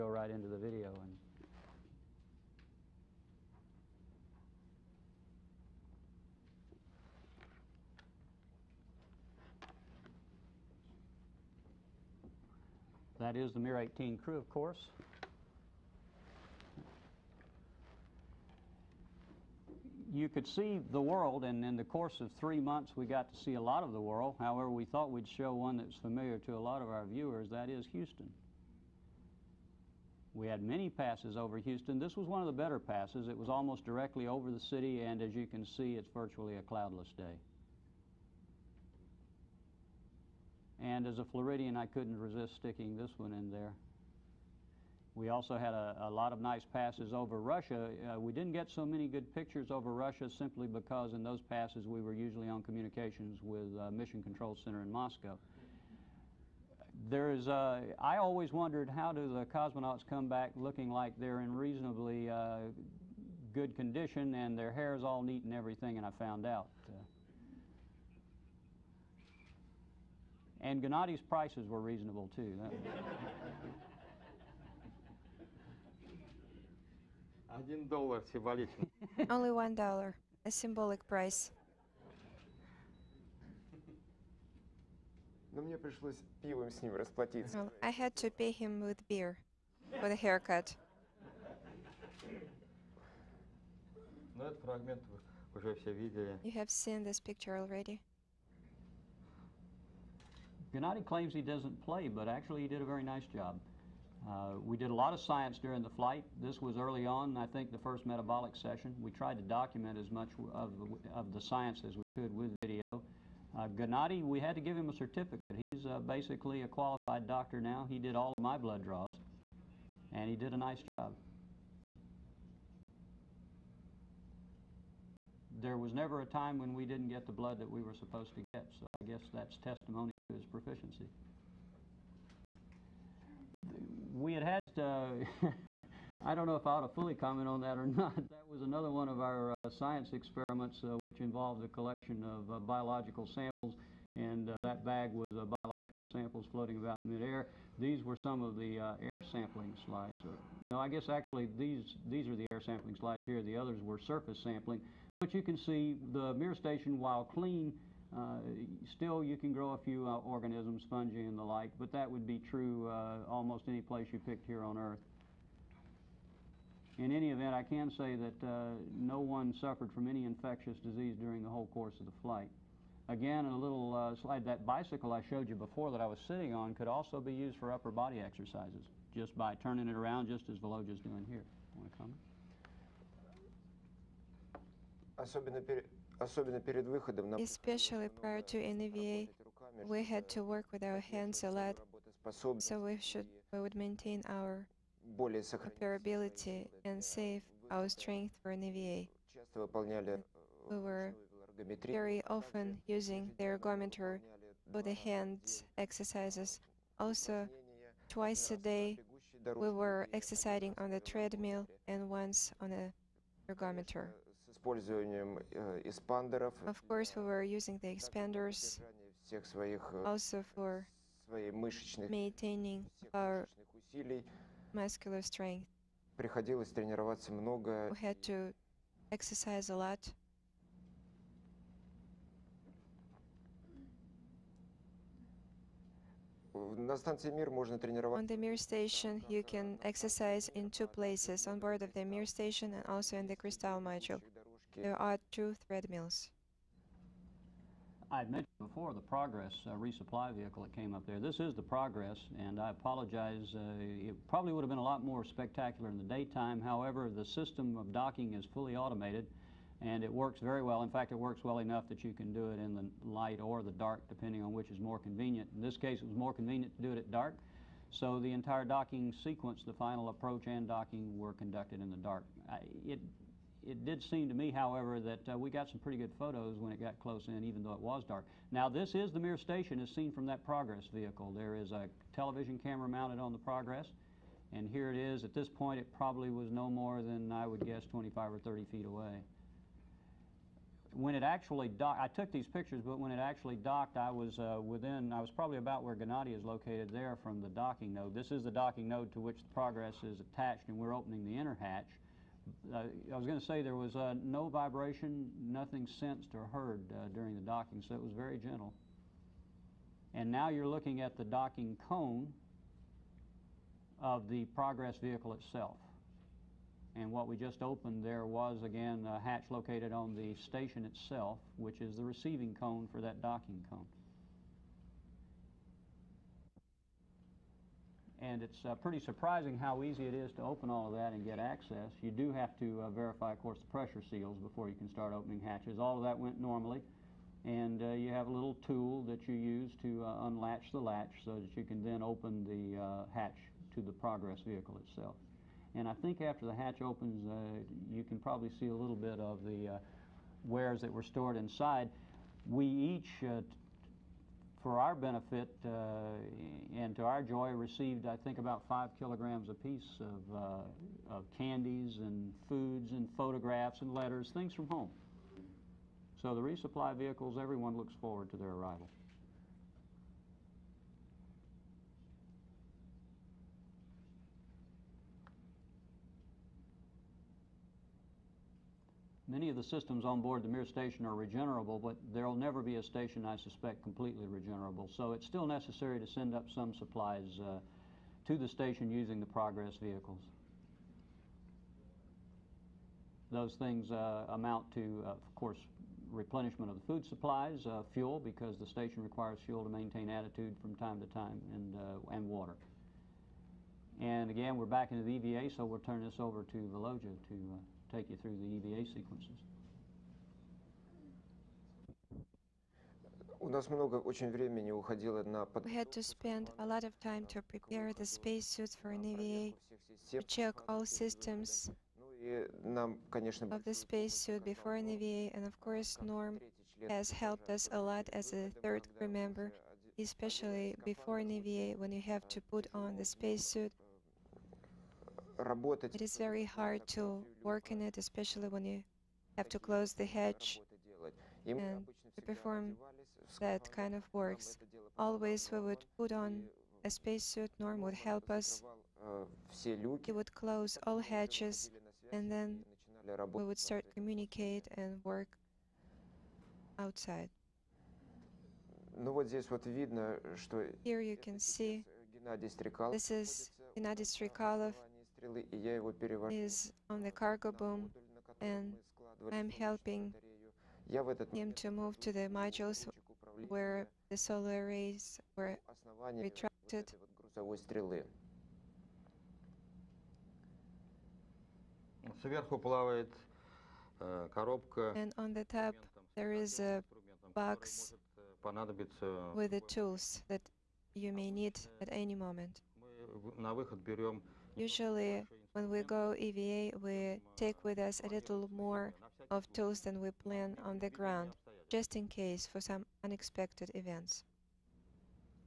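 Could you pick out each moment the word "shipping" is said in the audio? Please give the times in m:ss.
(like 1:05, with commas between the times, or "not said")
not said.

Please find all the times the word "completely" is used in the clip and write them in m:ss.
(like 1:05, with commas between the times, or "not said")
6:23.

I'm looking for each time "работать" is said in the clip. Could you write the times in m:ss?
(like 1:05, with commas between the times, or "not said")
7:15.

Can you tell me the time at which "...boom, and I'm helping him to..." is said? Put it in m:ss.
7:47.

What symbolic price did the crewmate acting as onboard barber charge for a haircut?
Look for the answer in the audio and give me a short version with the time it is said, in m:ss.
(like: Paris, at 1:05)
1 dollar, at 1:19.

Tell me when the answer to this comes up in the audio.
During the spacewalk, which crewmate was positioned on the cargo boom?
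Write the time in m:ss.
7:43.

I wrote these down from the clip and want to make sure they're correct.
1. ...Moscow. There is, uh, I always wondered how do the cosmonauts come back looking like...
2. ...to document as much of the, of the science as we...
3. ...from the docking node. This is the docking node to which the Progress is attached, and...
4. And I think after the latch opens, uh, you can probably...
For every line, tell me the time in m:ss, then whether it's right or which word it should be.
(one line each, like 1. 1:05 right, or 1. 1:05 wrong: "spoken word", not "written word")
1. 0:54 right
2. 1:49 right
3. 4:57 right
4. 5:45 wrong: "hatch", not "latch".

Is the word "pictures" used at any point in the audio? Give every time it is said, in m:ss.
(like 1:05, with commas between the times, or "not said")
0:49, 1:37, 4:52.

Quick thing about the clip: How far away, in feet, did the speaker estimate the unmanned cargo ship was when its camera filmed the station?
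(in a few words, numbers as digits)
25 or 30 feet.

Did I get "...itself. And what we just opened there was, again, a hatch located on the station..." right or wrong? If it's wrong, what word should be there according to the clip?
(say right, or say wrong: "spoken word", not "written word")
right.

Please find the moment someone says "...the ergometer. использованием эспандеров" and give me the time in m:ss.
3:32.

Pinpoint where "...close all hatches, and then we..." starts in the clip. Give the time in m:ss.
7:30.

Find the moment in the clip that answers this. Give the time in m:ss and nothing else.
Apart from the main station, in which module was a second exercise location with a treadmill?
4:03.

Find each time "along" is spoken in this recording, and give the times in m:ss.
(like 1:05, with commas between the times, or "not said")
not said.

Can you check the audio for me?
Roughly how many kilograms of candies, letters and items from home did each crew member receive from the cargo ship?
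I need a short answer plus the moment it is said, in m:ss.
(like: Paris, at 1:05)
5 kilograms, at 5:58.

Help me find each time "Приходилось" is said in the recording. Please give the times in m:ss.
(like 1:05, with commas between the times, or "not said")
3:46.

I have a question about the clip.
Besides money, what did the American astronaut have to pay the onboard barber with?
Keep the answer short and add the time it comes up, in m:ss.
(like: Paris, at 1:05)
beer, at 1:29.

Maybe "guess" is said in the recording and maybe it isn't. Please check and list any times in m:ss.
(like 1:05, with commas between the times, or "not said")
2:09, 2:30, 4:47.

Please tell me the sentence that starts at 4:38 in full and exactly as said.
Now, this is the Mir station as seen from that Progress vehicle.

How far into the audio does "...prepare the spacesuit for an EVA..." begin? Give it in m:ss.
6:57.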